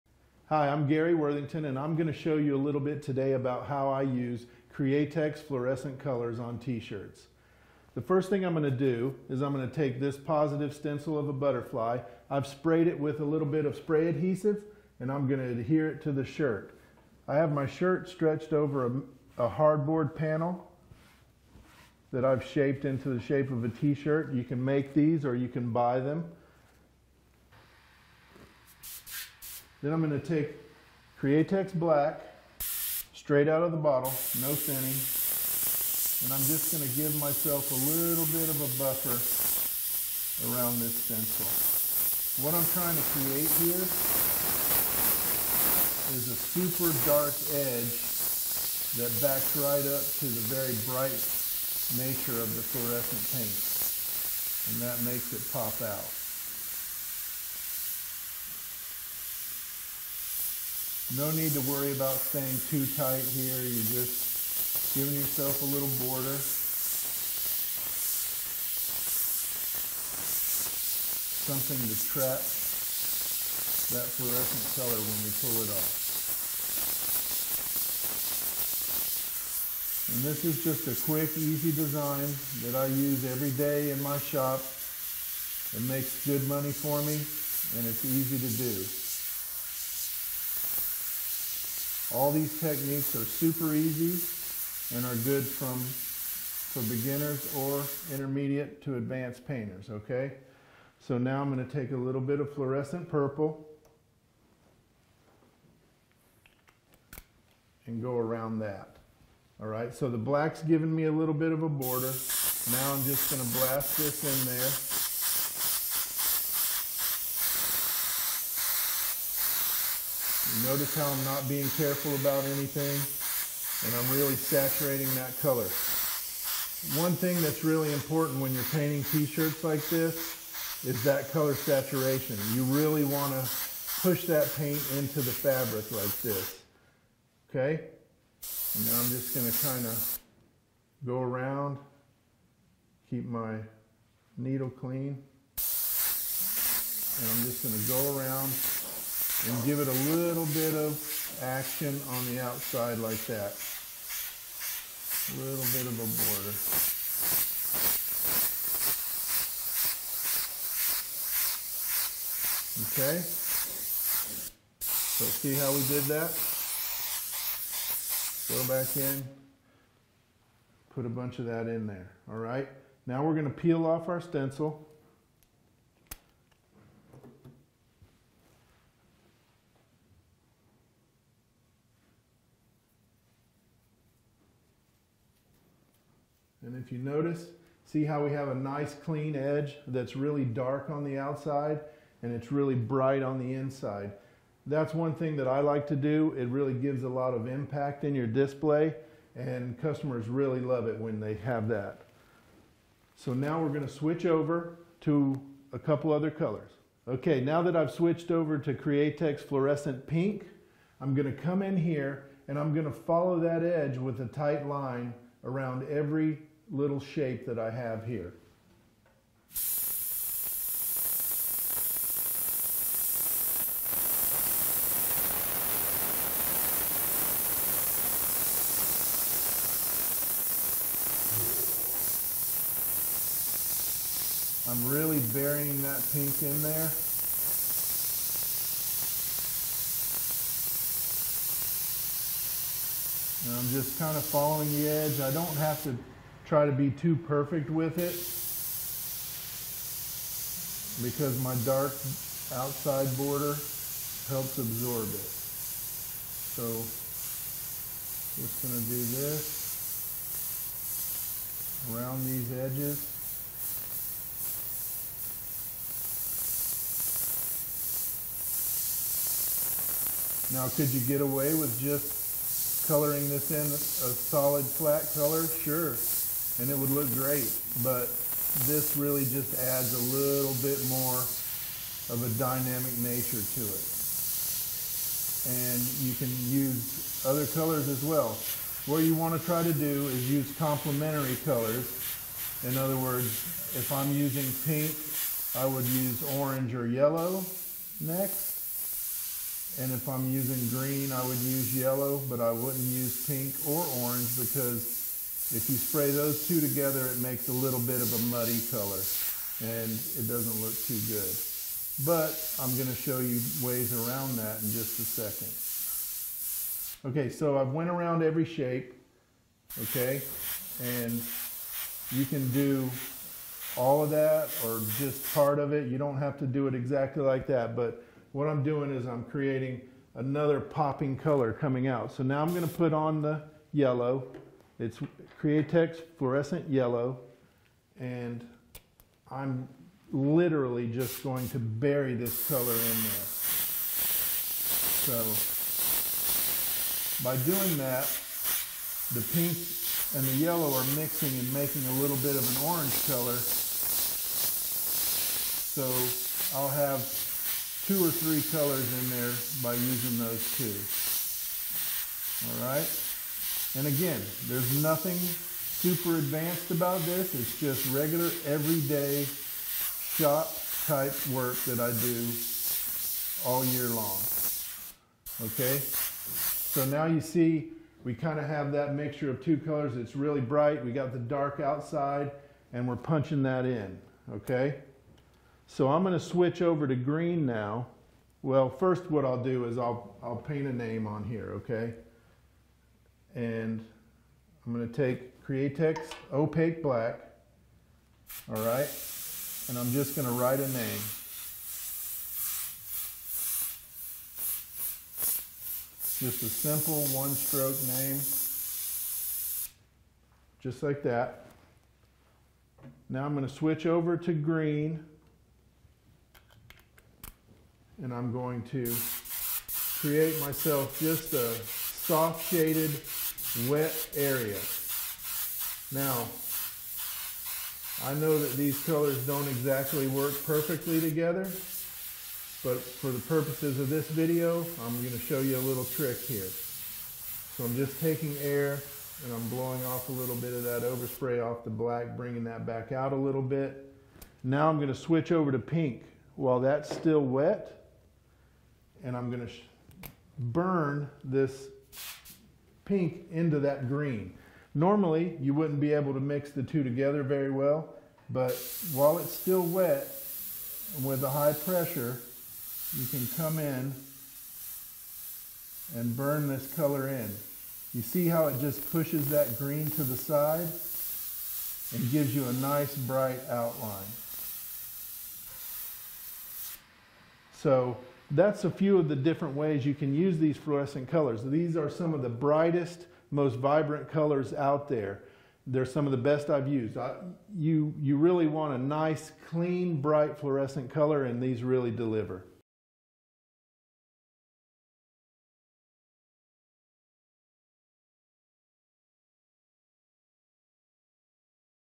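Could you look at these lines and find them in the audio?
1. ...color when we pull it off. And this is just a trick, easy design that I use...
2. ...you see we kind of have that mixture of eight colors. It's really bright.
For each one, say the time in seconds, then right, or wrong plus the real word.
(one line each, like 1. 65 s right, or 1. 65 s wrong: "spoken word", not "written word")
1. 74 s wrong: "quick", not "trick"
2. 377 s wrong: "two", not "eight".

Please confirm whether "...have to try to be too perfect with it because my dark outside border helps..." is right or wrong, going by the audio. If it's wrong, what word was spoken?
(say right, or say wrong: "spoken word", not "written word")
right.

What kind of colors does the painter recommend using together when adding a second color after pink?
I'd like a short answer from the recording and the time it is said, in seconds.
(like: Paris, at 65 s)
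Complementary colors, at 290 s.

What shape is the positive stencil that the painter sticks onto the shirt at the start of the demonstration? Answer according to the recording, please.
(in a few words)
Butterfly.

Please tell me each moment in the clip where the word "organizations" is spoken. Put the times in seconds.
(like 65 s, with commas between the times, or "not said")
not said.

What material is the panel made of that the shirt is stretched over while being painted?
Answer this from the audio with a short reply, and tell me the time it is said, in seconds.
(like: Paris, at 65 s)
Hardboard, at 19 s.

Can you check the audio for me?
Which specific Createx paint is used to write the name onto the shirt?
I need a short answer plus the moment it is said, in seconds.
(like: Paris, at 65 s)
Createx Opaque Black, at 395 s.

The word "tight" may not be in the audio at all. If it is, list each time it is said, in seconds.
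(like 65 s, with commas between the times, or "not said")
62 s, 214 s.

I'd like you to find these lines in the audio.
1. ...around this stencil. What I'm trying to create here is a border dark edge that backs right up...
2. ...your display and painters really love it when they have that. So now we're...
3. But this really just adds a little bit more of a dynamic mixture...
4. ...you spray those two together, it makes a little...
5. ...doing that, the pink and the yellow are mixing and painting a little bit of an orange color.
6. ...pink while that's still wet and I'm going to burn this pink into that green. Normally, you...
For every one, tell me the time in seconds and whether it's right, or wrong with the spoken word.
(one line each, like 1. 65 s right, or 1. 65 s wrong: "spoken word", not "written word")
1. 40 s wrong: "super", not "border"
2. 198 s wrong: "customers", not "painters"
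3. 277 s wrong: "nature", not "mixture"
4. 305 s right
5. 347 s wrong: "making", not "painting"
6. 445 s right.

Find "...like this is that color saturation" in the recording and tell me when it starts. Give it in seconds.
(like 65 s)
129 s.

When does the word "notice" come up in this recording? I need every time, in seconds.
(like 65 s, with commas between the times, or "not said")
120 s, 186 s.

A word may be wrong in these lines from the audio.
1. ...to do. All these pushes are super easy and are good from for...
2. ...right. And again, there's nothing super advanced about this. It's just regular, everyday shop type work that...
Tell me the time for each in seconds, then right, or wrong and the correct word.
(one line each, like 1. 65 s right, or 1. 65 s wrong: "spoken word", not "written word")
1. 88 s wrong: "techniques", not "pushes"
2. 362 s right.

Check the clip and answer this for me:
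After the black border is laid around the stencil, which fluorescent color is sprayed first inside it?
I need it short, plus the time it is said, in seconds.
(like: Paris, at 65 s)
Purple, at 102 s.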